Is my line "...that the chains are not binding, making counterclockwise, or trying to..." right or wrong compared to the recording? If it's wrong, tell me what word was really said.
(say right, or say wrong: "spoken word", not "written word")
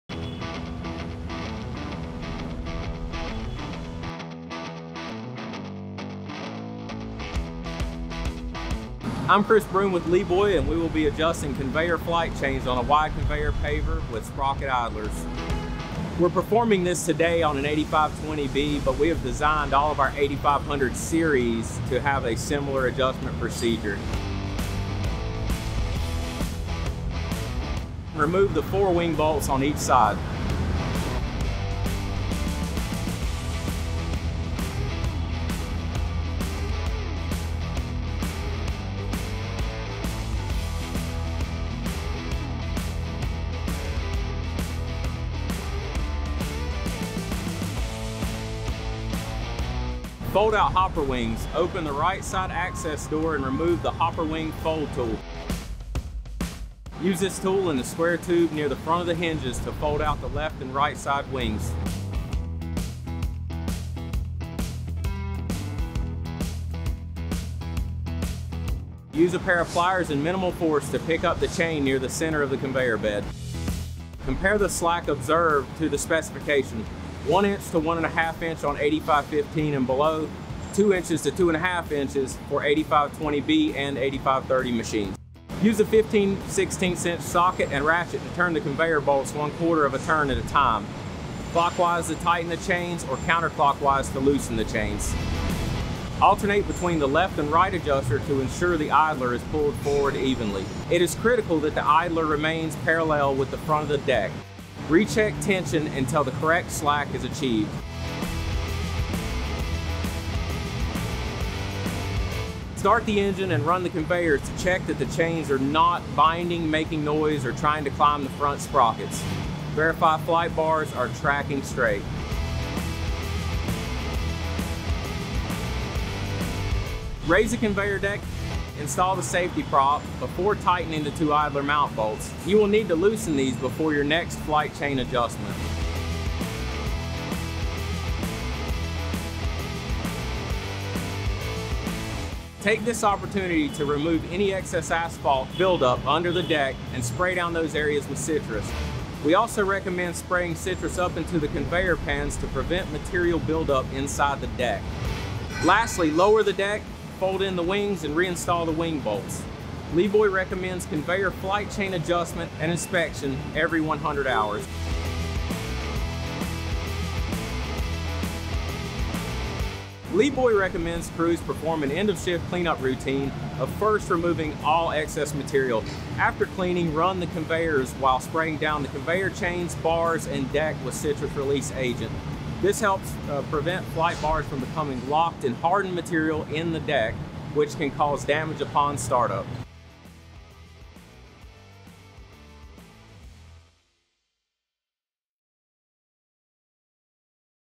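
wrong: "noise", not "counterclockwise".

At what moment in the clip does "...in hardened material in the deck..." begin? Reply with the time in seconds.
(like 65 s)
185 s.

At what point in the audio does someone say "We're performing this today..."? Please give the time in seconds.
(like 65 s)
16 s.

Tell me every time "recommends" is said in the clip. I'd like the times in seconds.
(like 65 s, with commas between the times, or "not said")
149 s, 160 s, 170 s.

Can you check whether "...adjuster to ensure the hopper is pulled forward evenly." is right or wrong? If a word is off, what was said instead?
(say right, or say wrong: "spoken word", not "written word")
wrong: "idler", not "hopper".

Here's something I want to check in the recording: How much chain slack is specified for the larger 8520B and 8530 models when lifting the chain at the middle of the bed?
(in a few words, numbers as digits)
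2 to 2.5 inches.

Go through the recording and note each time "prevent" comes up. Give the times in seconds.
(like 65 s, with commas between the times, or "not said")
152 s, 183 s.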